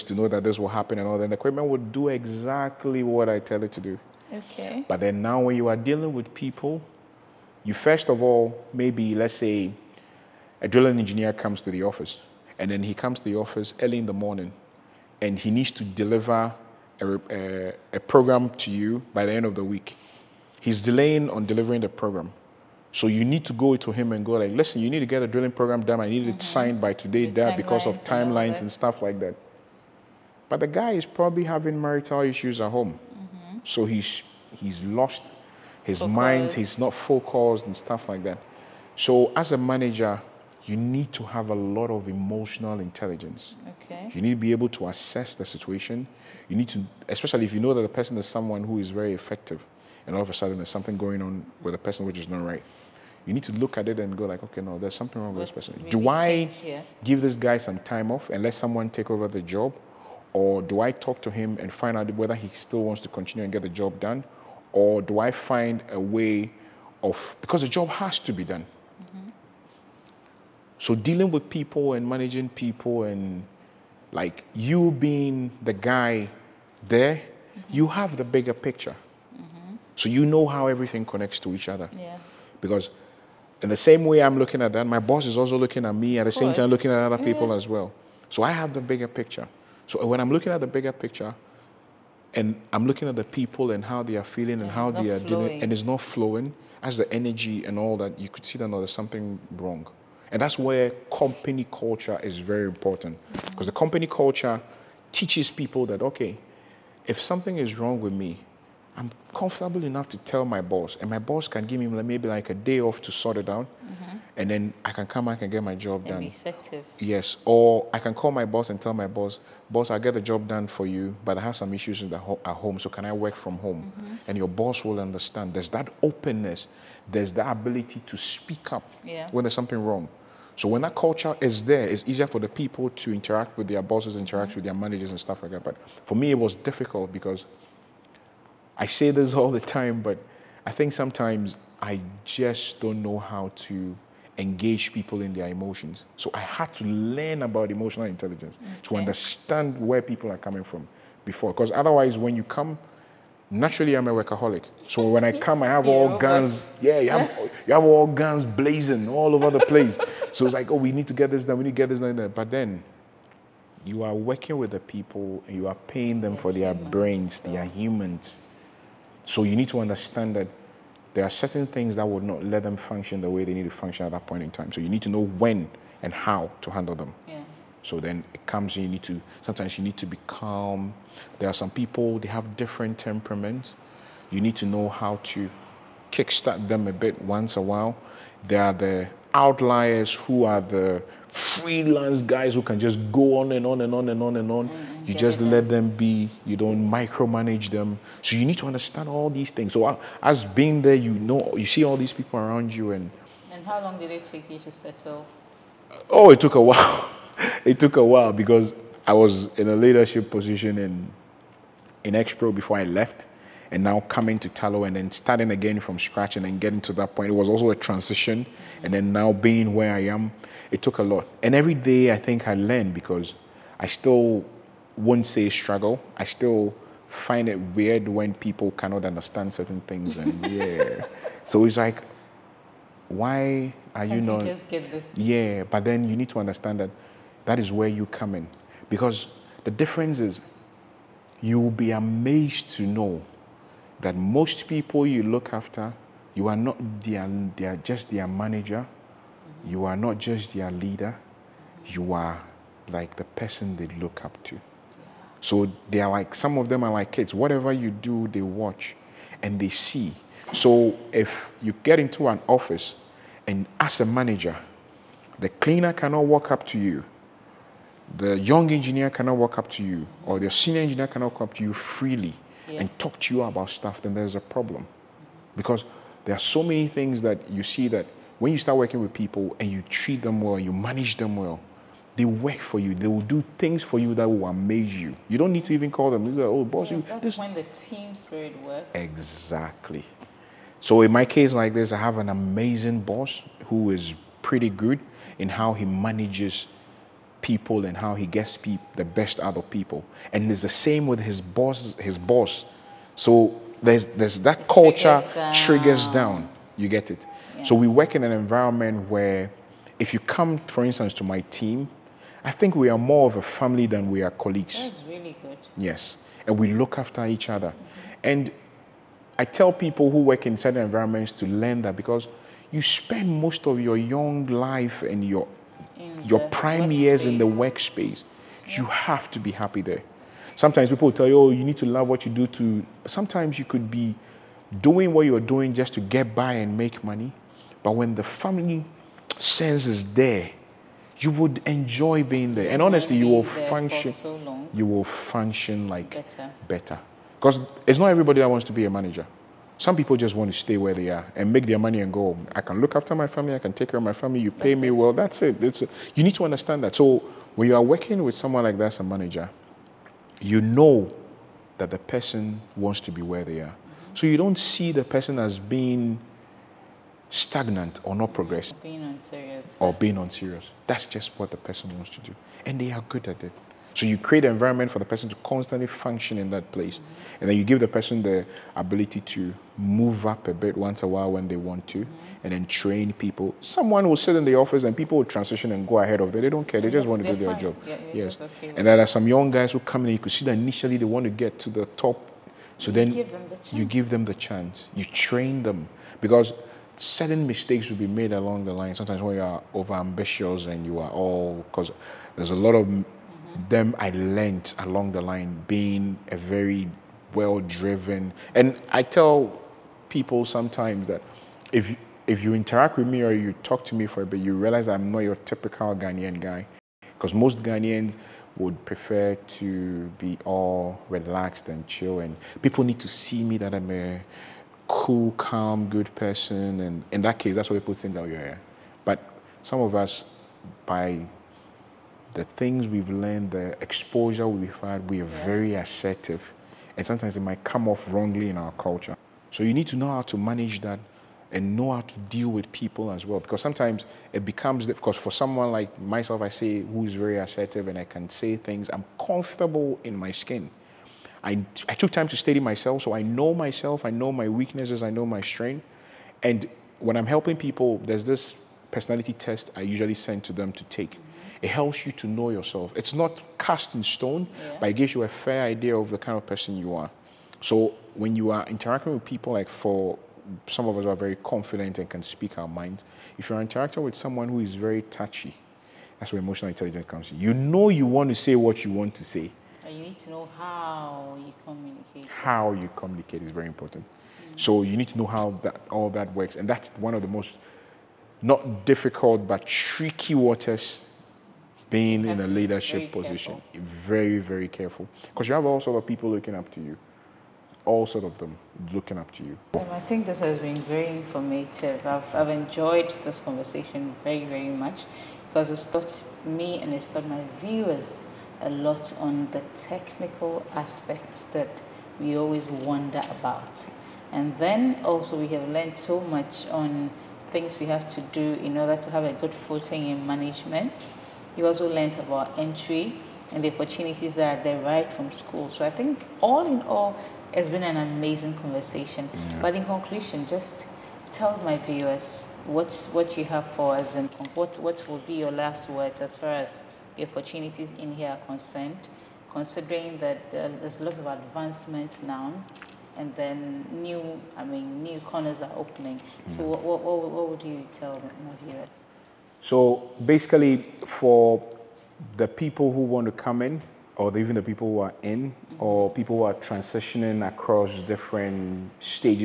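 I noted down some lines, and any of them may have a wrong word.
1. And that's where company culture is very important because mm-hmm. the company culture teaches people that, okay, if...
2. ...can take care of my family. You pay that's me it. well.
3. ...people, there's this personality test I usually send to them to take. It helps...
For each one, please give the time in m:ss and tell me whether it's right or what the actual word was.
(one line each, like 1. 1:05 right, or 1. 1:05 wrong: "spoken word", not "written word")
1. 1:40 right
2. 5:53 right
3. 7:37 right.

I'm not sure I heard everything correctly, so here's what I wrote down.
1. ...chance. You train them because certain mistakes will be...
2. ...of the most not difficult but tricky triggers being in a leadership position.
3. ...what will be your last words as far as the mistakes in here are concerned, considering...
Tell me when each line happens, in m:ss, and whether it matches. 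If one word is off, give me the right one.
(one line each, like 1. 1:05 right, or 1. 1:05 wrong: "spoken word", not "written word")
1. 6:34 right
2. 8:07 wrong: "waters", not "triggers"
3. 8:54 wrong: "opportunities", not "mistakes".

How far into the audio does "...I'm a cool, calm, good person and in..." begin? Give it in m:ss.
7:03.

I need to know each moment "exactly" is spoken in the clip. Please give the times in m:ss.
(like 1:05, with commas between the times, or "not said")
0:02, 4:48.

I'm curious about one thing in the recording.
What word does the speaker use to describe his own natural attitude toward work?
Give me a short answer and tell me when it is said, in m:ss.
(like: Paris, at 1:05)
Workaholic, at 2:34.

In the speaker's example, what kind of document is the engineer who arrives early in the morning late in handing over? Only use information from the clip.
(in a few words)
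Drilling program.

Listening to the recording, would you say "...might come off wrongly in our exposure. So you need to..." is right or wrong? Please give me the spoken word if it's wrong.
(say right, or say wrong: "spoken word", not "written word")
wrong: "culture", not "exposure".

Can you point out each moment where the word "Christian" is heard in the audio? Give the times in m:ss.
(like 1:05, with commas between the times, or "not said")
not said.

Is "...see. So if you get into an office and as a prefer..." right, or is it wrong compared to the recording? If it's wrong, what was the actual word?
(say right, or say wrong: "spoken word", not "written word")
wrong: "manager", not "prefer".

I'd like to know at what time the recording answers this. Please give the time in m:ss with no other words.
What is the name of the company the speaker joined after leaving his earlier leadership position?
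3:34.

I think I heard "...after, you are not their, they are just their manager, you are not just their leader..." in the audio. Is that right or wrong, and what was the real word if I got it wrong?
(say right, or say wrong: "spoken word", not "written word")
right.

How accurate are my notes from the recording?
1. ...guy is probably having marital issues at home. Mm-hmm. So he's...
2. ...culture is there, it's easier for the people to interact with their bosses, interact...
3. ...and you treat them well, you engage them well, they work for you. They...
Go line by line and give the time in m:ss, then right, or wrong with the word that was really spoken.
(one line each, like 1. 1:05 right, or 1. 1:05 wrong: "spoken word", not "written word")
1. 0:30 right
2. 2:10 right
3. 4:39 wrong: "manage", not "engage".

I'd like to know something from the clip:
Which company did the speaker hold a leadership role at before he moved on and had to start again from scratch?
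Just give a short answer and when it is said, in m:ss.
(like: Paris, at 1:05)
Expro, at 3:32.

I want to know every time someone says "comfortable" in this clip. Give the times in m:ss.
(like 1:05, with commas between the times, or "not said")
1:49, 7:29.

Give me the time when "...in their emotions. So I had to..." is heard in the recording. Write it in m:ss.
2:25.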